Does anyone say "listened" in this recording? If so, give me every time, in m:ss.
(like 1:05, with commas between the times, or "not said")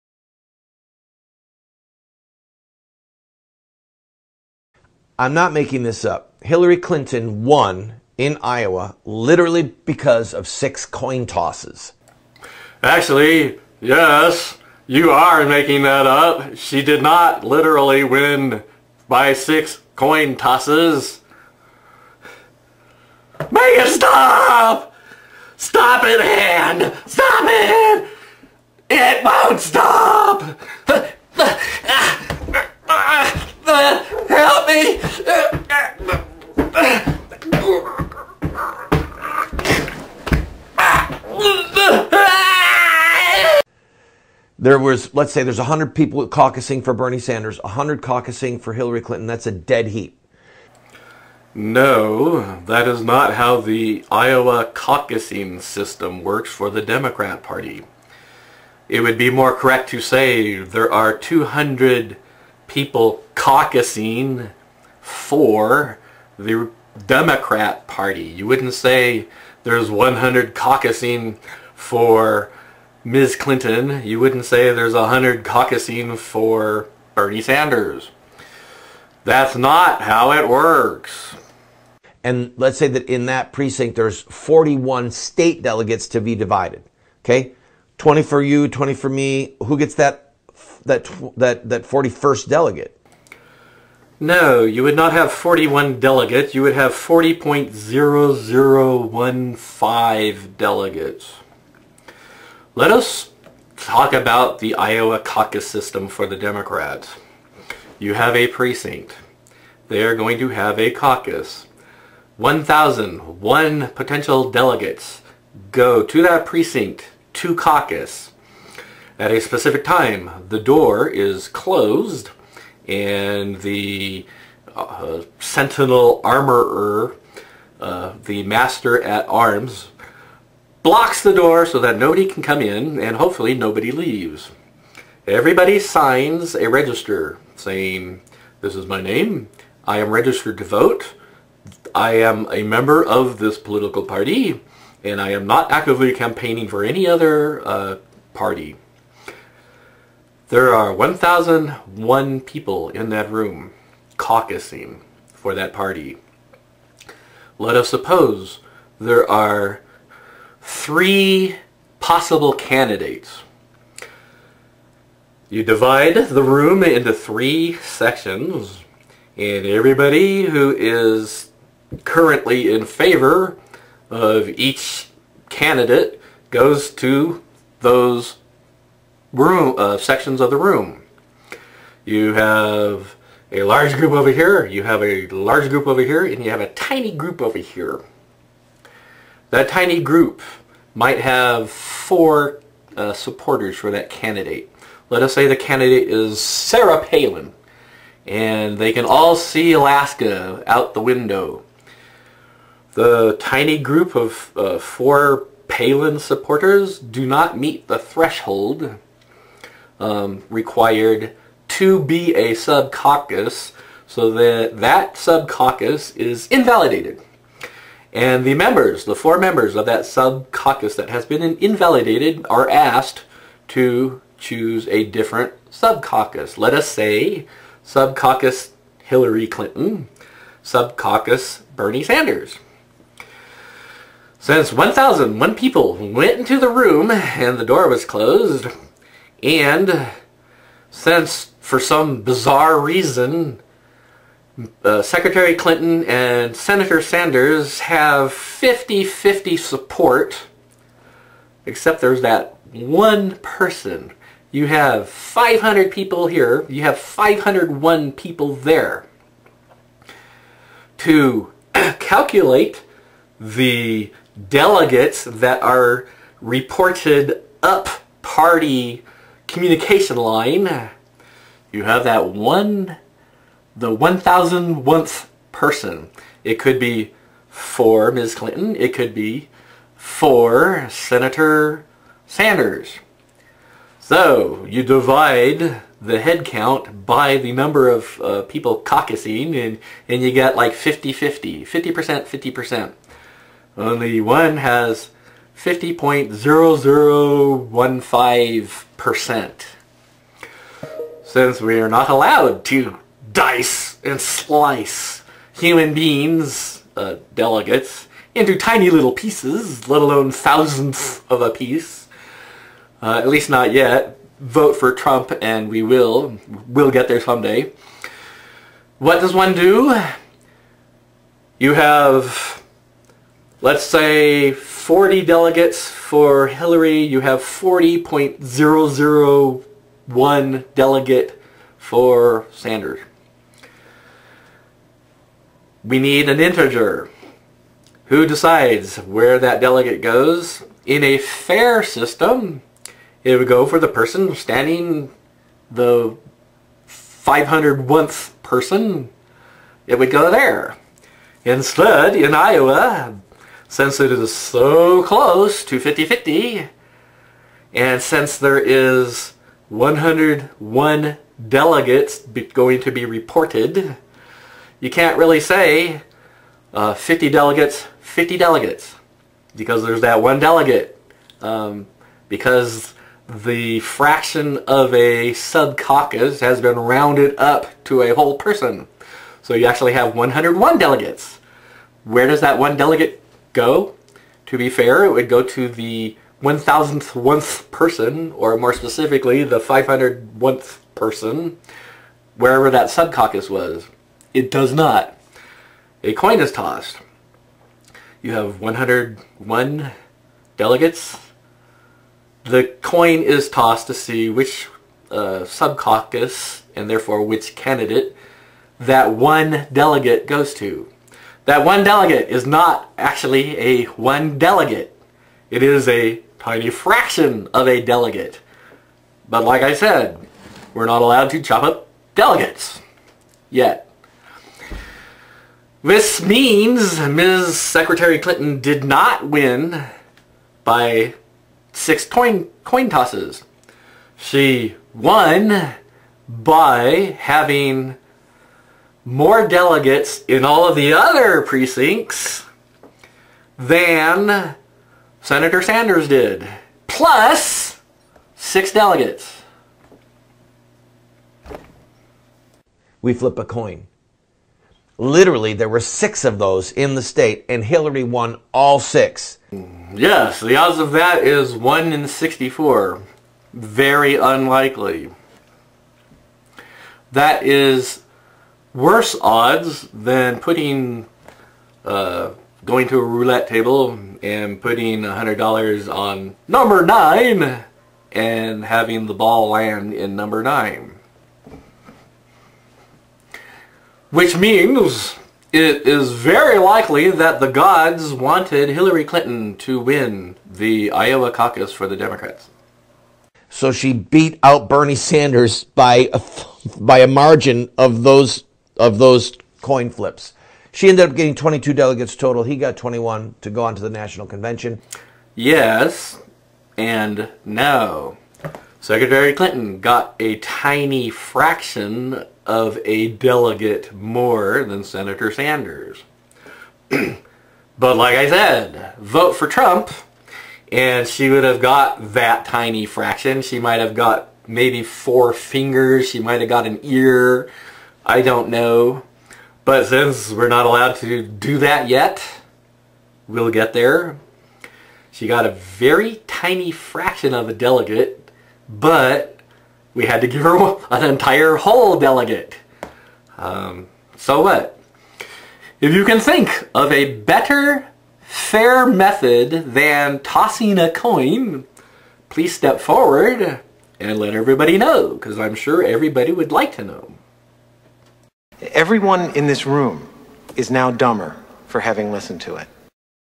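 9:22.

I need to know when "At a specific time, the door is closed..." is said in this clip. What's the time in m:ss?
1:59.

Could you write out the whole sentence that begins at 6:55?
It is a tiny fraction of a delegate.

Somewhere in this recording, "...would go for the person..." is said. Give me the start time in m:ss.
5:43.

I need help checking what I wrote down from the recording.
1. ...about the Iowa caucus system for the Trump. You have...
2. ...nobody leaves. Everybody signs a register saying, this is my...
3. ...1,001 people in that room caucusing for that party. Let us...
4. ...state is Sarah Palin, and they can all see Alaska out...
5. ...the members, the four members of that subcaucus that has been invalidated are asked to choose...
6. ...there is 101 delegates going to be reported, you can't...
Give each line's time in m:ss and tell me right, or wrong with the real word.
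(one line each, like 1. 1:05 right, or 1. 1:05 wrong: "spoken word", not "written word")
1. 1:44 wrong: "Democrats", not "Trump"
2. 2:13 right
3. 2:30 right
4. 3:15 wrong: "candidate", not "state"
5. 3:38 right
6. 5:58 right.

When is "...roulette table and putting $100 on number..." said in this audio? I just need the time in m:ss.
7:53.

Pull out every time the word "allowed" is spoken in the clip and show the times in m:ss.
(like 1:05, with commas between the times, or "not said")
5:02, 7:01, 8:50.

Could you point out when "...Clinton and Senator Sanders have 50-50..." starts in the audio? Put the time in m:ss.
4:05.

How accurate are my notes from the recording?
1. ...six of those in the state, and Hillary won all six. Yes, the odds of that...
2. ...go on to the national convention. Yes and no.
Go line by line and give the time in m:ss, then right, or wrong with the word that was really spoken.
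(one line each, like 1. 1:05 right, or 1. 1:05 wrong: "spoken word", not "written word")
1. 7:35 right
2. 8:23 right.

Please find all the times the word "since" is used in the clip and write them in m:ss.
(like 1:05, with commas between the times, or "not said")
3:54, 4:00, 5:01, 5:53, 5:58, 8:49.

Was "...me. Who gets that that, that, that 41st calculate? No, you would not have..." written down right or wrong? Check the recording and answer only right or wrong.
wrong.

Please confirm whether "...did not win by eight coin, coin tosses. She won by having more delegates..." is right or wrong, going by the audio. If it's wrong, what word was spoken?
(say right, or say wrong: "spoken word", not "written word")
wrong: "six", not "eight".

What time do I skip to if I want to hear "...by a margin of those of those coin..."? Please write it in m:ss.
8:16.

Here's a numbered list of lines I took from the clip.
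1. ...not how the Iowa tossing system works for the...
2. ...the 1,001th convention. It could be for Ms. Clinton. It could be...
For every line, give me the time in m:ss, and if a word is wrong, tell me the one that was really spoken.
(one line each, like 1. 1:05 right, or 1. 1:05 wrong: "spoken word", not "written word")
1. 0:53 wrong: "caucusing", not "tossing"
2. 4:33 wrong: "person", not "convention".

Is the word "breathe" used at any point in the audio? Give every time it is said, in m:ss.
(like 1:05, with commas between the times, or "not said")
not said.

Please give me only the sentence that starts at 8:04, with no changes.
Which means it is very likely that the gods wanted Hillary Clinton to win the Iowa caucus for the Democrats.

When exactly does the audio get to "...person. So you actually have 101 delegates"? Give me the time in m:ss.
6:18.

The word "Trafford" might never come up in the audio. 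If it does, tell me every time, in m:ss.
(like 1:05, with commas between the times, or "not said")
not said.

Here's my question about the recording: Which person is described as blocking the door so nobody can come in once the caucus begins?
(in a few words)
master at arms.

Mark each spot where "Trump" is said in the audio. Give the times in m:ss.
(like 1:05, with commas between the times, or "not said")
5:14, 8:39.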